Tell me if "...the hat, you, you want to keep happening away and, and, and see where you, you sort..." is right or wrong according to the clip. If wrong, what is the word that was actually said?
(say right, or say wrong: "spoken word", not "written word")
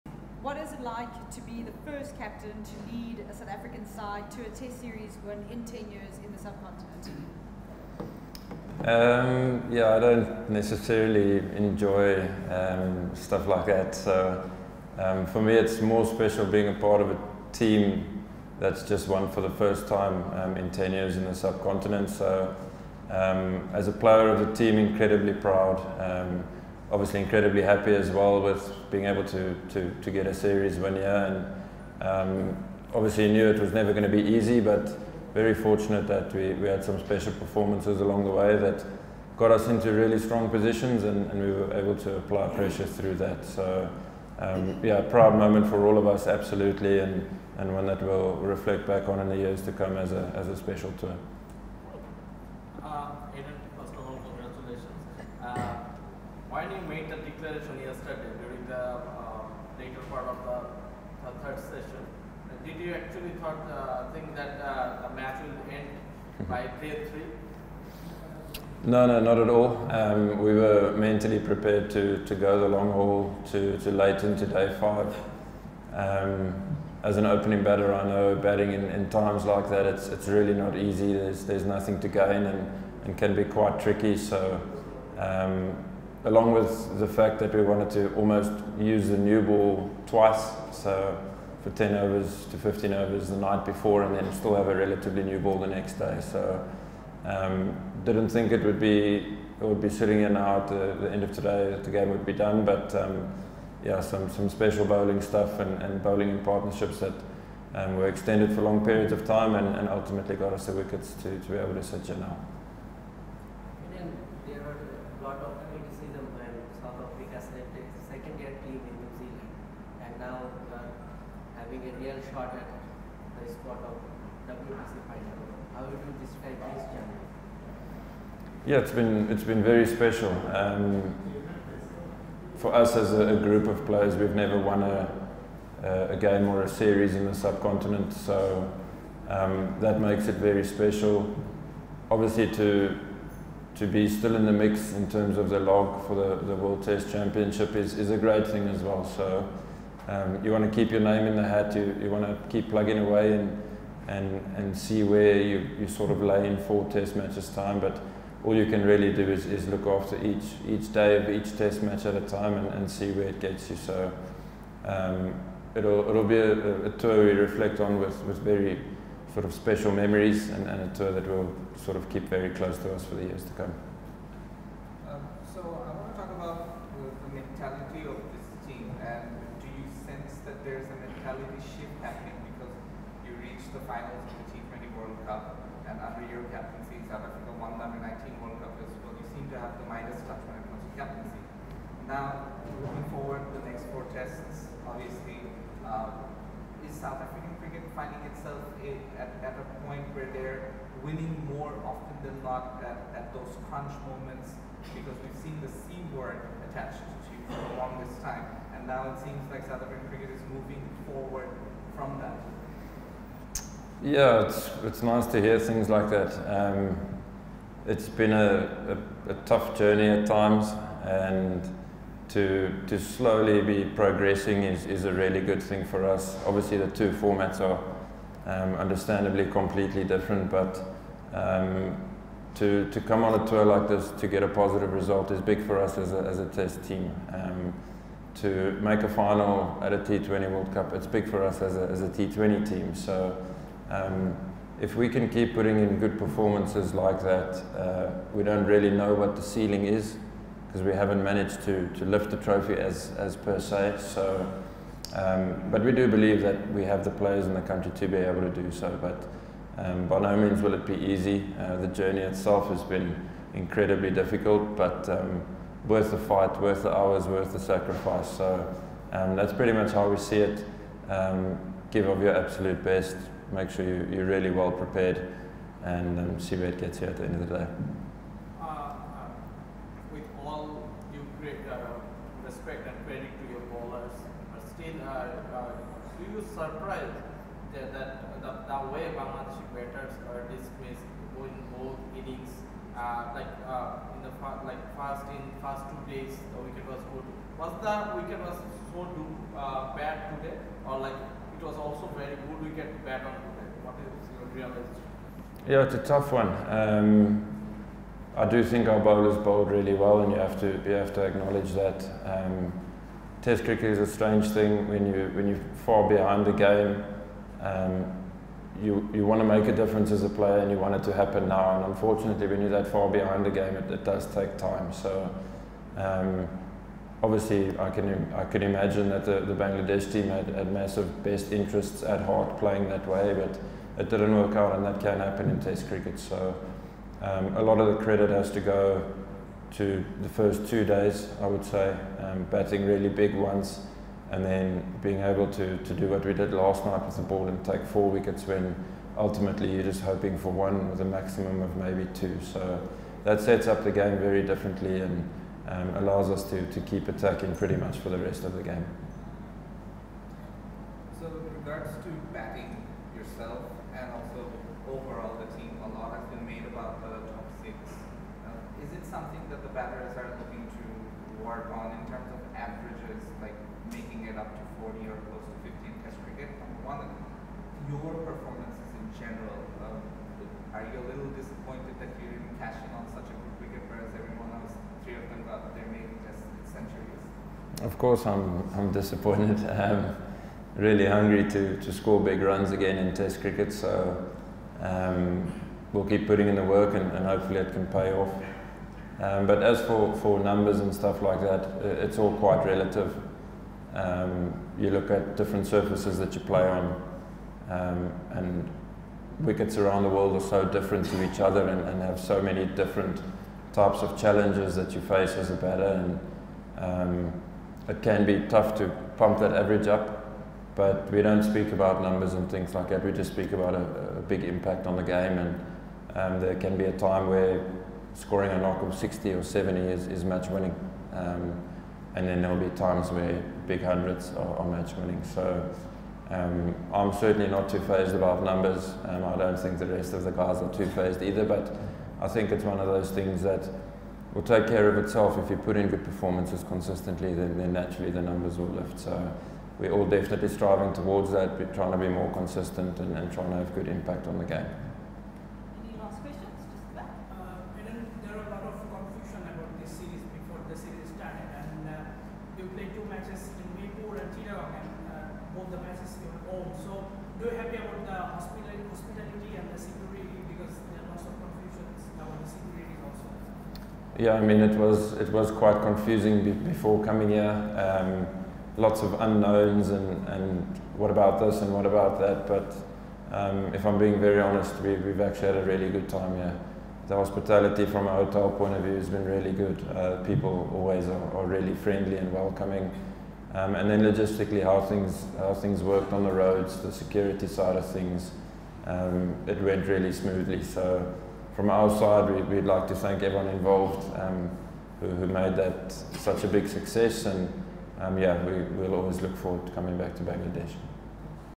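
wrong: "plugging", not "happening".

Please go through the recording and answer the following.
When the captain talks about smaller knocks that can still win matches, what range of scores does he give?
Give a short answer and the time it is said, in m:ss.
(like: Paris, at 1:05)
60 or 70, at 7:08.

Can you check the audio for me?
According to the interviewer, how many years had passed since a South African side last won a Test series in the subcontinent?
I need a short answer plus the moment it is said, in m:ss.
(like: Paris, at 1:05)
10, at 0:05.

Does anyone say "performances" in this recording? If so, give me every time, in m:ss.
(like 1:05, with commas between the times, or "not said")
0:37, 4:06, 6:18, 7:26.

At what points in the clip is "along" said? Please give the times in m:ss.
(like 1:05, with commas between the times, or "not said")
0:38, 1:26.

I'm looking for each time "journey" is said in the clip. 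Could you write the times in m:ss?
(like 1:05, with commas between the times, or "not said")
2:06, 3:39, 4:21.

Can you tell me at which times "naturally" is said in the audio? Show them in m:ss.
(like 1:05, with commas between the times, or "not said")
7:27.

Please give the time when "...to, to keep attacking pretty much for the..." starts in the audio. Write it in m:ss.
5:56.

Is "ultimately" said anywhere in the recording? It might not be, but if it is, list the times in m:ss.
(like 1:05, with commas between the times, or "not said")
1:49, 5:49.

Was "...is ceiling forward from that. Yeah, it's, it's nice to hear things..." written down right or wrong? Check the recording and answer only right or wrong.
wrong.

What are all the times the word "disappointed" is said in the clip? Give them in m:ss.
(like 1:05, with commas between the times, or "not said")
6:21, 6:28.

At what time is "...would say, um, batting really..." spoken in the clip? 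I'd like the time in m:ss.
5:41.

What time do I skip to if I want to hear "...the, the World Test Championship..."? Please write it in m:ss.
2:26.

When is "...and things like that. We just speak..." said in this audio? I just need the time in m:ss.
7:02.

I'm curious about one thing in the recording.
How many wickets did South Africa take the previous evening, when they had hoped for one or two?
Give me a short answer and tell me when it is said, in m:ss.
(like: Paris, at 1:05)
4, at 5:47.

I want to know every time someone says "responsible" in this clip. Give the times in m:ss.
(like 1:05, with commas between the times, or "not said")
not said.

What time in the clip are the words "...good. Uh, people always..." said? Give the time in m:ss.
8:09.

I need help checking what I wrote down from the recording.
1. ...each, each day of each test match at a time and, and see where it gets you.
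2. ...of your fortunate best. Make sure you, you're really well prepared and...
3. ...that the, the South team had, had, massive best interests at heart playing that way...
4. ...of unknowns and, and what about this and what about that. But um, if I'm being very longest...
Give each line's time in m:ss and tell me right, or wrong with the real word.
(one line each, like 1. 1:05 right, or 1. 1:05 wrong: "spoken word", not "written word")
1. 2:40 right
2. 4:32 wrong: "absolute", not "fortunate"
3. 5:29 wrong: "Bangladesh", not "South"
4. 7:59 wrong: "honest", not "longest".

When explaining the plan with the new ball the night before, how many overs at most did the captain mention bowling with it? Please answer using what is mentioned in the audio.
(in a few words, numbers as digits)
15.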